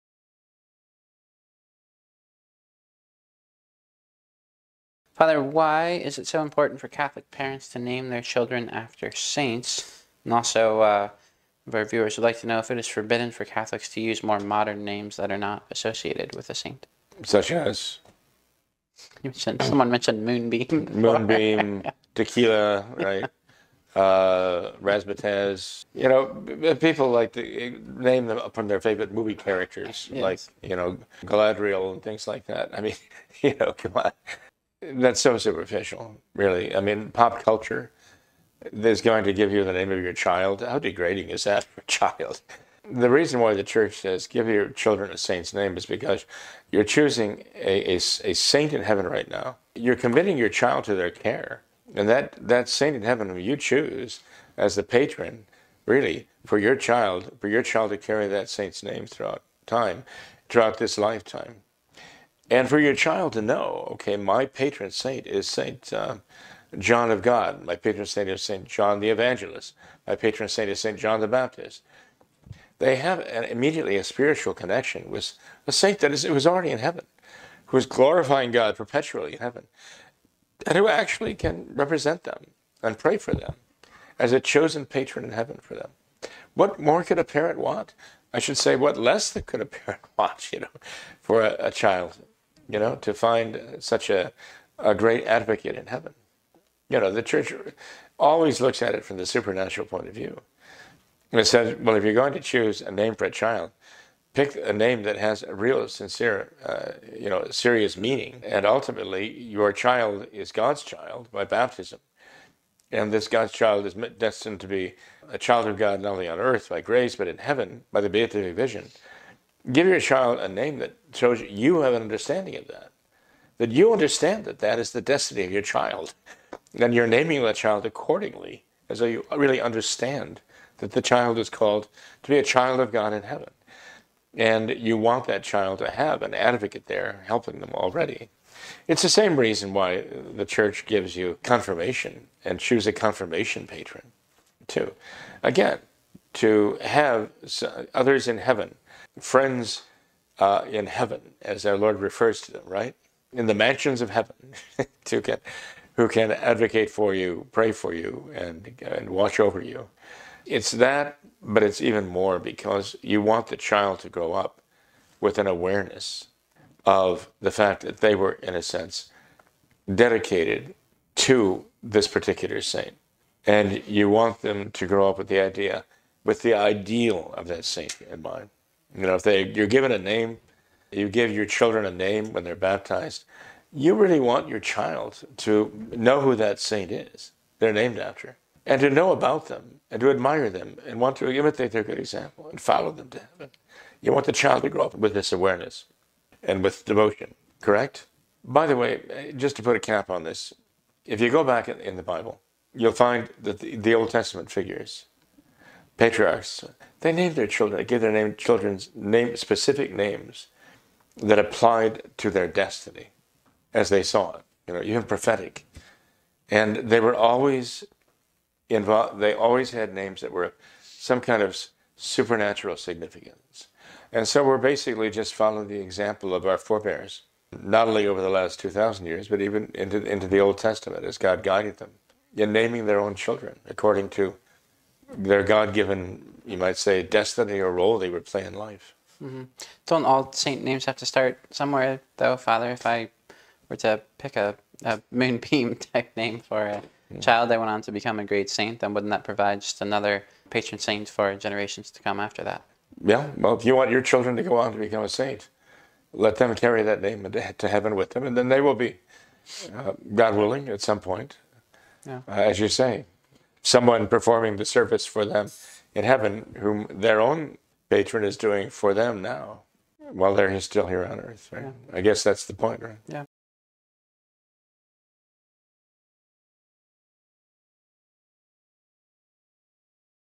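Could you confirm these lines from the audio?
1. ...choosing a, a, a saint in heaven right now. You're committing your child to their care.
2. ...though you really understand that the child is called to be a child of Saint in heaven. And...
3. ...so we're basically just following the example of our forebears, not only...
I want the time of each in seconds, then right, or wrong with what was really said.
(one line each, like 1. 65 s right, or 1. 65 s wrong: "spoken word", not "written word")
1. 46 s right
2. 128 s wrong: "God", not "Saint"
3. 224 s right.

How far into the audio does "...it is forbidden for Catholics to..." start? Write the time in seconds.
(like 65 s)
12 s.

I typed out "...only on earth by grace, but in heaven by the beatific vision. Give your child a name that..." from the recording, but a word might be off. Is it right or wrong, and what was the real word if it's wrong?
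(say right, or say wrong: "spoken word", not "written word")
right.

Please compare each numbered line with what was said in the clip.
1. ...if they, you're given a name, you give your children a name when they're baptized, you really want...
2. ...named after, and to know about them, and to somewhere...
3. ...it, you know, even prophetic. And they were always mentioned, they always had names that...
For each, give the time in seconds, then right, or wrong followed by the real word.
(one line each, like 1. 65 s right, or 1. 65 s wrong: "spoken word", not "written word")
1. 179 s right
2. 187 s wrong: "admire", not "somewhere"
3. 214 s wrong: "involved", not "mentioned".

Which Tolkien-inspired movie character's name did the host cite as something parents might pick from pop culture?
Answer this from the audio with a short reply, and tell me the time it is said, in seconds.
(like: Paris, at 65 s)
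Galadriel, at 31 s.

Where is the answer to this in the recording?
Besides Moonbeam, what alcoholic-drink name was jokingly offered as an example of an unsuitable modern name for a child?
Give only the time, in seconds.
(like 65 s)
22 s.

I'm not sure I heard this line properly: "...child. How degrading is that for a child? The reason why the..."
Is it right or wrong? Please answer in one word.
right.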